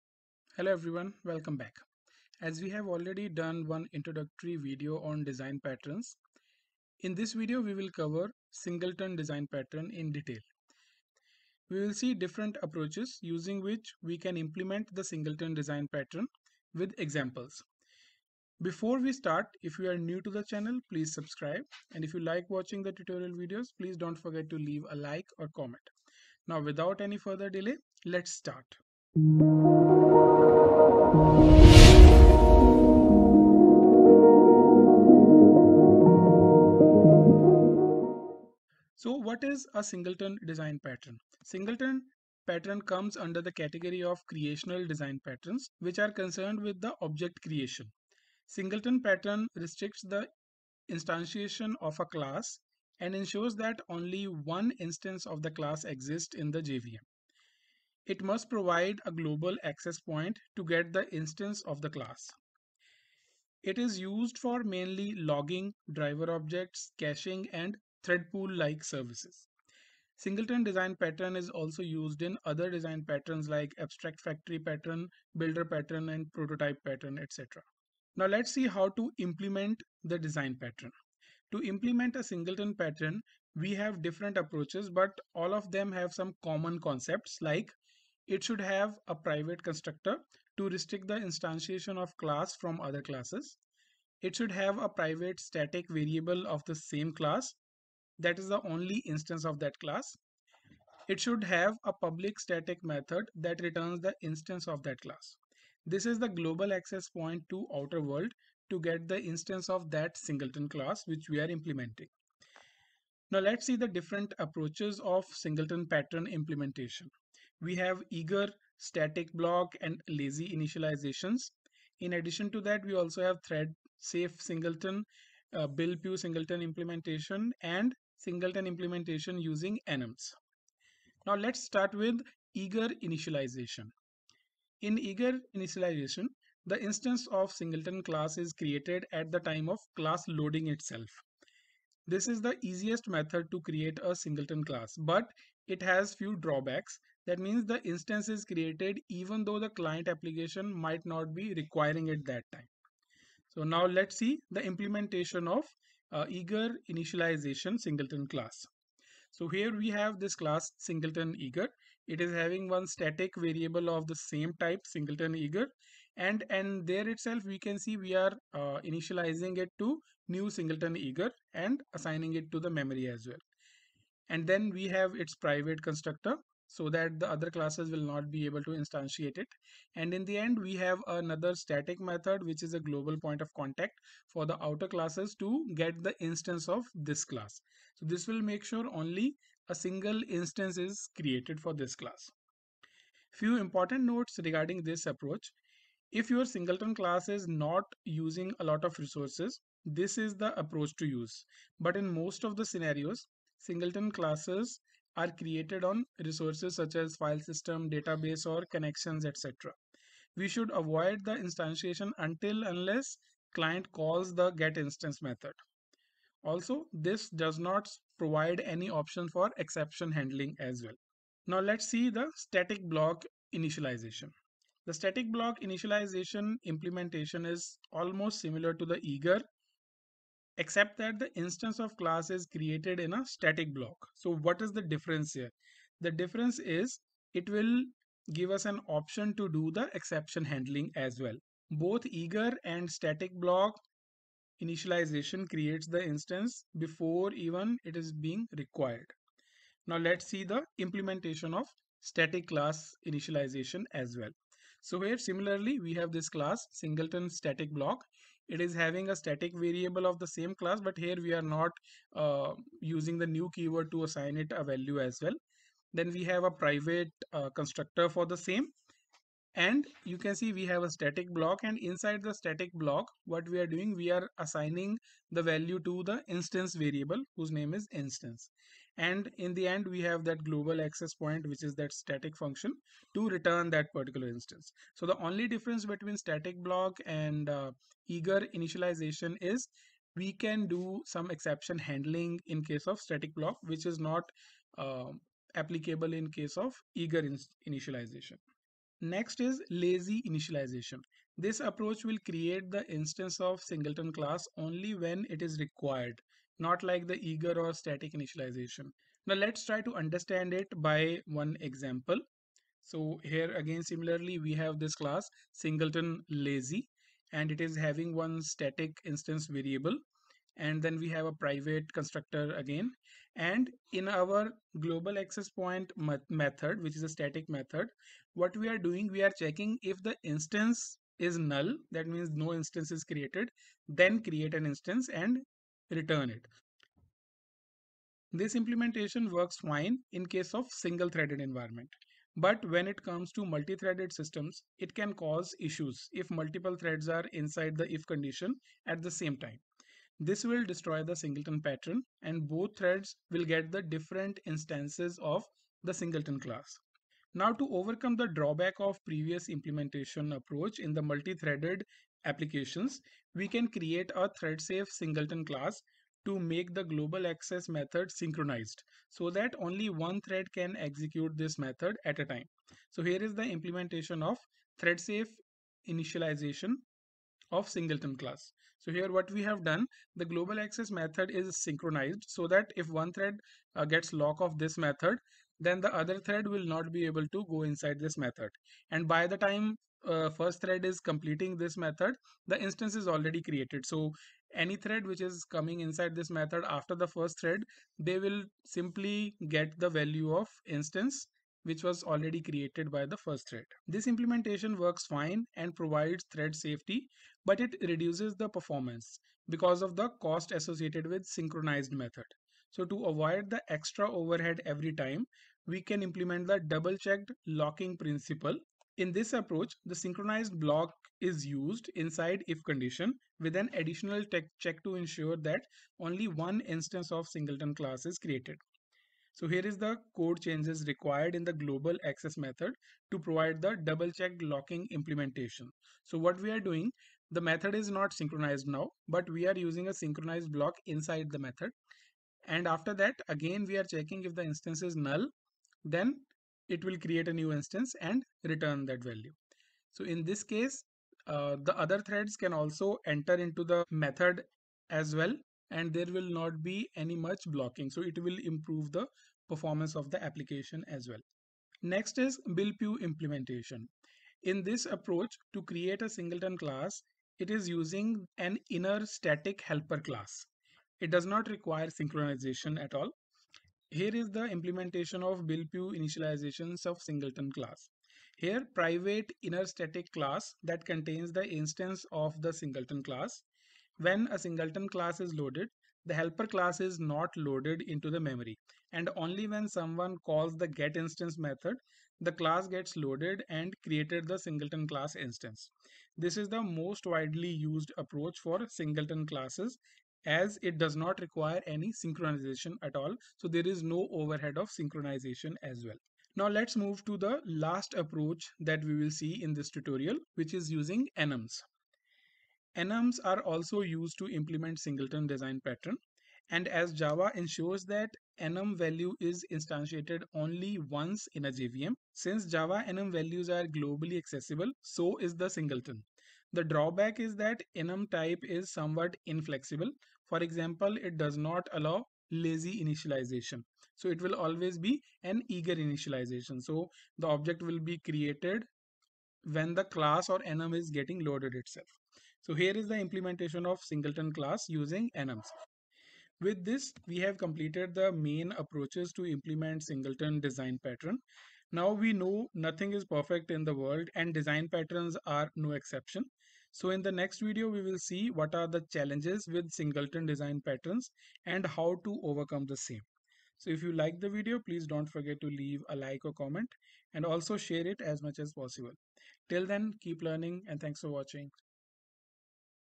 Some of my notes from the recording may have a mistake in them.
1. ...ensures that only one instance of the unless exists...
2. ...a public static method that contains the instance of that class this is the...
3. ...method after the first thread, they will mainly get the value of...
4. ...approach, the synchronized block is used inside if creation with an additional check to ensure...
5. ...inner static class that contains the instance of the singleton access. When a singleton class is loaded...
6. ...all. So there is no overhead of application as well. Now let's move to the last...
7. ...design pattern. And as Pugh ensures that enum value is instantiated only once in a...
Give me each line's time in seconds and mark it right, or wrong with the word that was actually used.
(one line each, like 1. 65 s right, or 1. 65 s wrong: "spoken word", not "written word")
1. 53 s wrong: "class", not "unless"
2. 101 s wrong: "returns", not "contains"
3. 396 s wrong: "simply", not "mainly"
4. 419 s wrong: "condition", not "creation"
5. 479 s wrong: "class", not "access"
6. 502 s wrong: "synchronization", not "application"
7. 515 s wrong: "Java", not "Pugh".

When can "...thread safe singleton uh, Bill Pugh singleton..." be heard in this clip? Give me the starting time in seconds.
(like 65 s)
123 s.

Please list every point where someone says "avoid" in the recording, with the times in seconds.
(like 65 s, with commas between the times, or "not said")
210 s, 413 s.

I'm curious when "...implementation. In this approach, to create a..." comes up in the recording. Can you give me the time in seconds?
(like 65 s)
463 s.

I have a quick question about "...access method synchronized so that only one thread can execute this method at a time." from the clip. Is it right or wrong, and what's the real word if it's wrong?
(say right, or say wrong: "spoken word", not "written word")
right.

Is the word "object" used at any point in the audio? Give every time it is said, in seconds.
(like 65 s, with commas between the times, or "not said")
47 s, 66 s, 537 s.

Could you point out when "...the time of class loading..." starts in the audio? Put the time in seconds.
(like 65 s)
139 s.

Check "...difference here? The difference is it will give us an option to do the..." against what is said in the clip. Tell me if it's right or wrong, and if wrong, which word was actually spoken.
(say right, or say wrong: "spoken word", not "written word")
right.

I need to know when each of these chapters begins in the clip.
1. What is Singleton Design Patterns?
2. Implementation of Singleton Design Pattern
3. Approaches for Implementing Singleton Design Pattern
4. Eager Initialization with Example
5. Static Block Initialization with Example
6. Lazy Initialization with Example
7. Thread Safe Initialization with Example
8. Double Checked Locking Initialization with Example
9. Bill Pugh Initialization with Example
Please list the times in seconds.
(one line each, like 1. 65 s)
1. 38 s
2. 77 s
3. 113 s
4. 130 s
5. 221 s
6. 297 s
7. 356 s
8. 405 s
9. 461 s.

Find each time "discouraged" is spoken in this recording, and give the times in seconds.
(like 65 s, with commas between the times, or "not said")
not said.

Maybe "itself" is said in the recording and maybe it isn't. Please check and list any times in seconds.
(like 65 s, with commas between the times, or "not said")
140 s, 167 s, 541 s.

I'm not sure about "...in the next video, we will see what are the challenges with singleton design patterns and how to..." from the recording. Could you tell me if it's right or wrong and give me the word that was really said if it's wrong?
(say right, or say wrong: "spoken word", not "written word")
right.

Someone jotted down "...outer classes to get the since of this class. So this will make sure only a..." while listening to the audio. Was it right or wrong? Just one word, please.
wrong.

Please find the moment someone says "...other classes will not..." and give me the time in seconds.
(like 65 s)
177 s.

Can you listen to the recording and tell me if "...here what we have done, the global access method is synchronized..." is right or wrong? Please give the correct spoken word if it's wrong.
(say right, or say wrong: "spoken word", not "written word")
right.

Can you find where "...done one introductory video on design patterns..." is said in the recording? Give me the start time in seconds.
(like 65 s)
3 s.